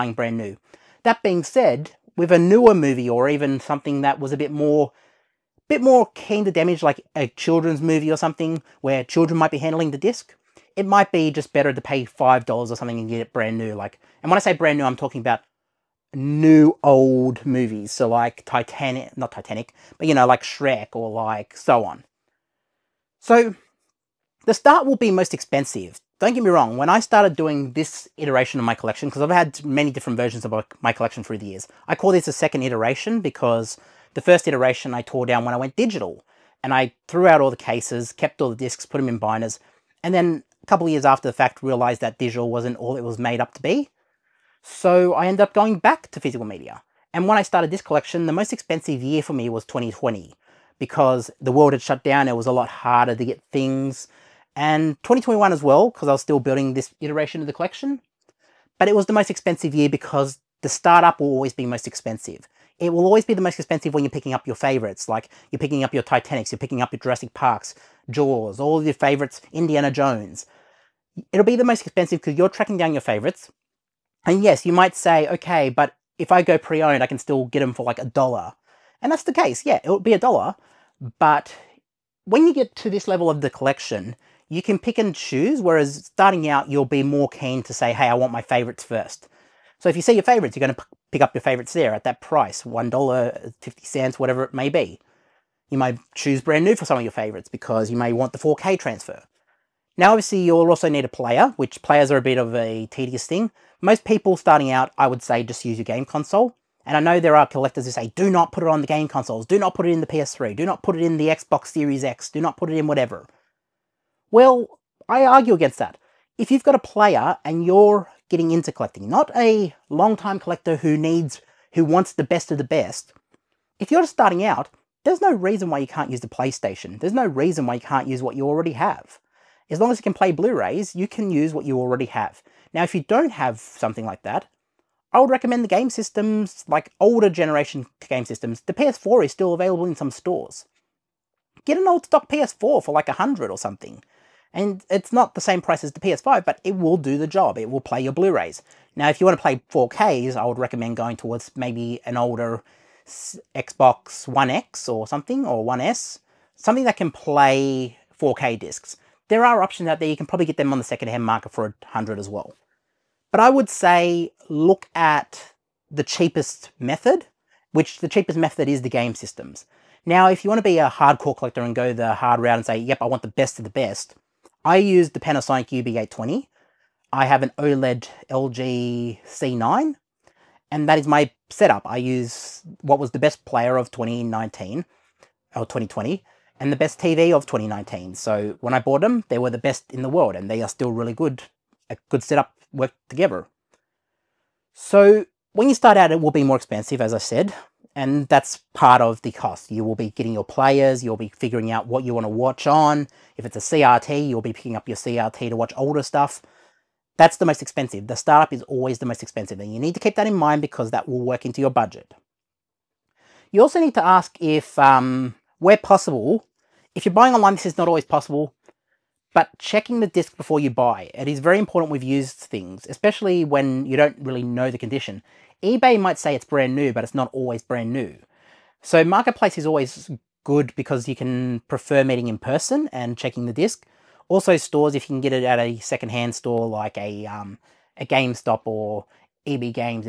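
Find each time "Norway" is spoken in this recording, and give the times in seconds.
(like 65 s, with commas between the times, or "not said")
not said.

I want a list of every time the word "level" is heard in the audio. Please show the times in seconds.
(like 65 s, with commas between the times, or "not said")
83 s.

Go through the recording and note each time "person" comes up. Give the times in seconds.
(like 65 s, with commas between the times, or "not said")
232 s.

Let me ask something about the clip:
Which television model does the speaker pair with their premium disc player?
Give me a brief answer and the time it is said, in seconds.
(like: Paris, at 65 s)
LG C9, at 178 s.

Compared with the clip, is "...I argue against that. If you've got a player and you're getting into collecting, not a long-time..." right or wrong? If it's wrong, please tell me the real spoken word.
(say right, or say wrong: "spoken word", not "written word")
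right.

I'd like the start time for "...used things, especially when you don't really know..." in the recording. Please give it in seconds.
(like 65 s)
222 s.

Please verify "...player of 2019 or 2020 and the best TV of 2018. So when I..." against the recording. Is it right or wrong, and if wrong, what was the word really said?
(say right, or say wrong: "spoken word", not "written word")
wrong: "2019", not "2018".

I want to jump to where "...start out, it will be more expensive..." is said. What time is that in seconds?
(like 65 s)
195 s.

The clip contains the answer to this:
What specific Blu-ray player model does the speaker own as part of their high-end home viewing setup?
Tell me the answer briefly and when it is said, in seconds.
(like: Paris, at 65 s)
Panasonic UB820, at 175 s.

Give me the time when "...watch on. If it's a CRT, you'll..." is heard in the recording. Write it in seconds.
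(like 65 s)
202 s.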